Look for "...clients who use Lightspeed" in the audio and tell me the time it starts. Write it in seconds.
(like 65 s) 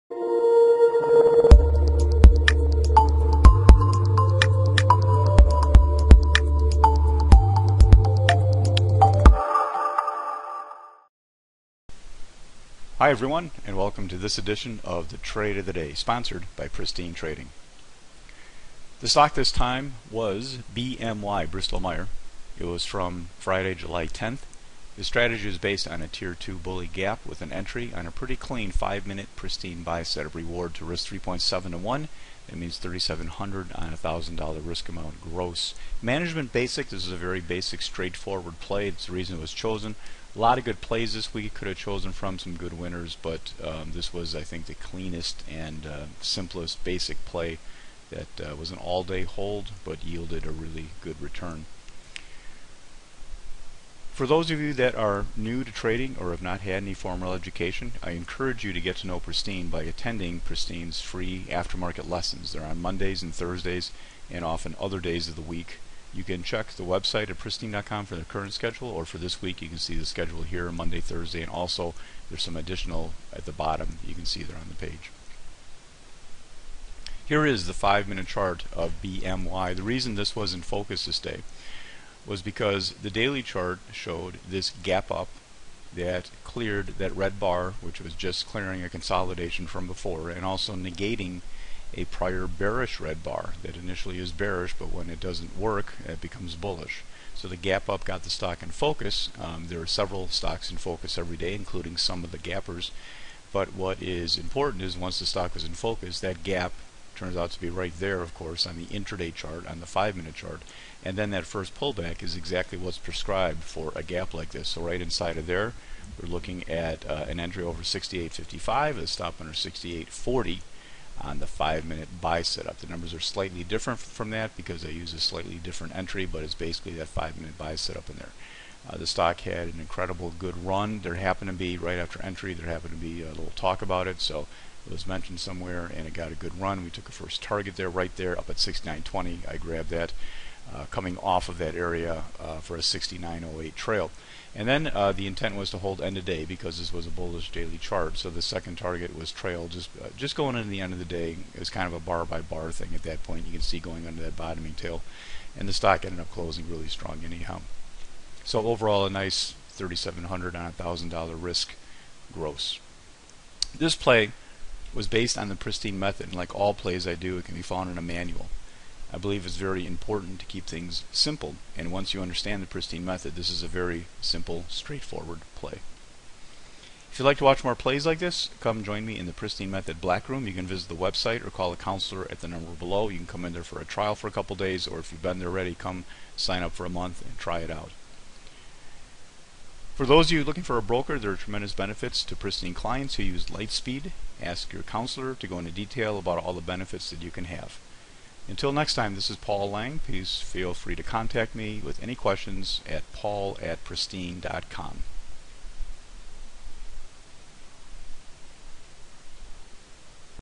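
192 s.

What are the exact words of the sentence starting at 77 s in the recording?
Here is the five minute chart of BMY.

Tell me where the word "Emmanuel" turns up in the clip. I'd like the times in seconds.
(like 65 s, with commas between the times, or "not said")
not said.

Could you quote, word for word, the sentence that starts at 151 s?
It was kind of a bar by bar thing at that point.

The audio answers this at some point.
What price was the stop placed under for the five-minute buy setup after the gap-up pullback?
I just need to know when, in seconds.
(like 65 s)
119 s.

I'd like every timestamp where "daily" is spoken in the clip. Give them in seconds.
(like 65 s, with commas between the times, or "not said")
83 s, 147 s.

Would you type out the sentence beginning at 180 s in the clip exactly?
You can visit the website or call a counselor at the number below.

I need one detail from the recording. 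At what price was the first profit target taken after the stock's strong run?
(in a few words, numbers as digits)
69.20.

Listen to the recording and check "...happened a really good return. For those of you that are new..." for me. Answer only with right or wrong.
wrong.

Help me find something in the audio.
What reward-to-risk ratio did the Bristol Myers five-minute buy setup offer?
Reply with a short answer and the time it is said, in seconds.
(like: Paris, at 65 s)
3.7 to 1, at 31 s.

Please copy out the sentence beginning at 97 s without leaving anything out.
So the gap up got the stock in focus.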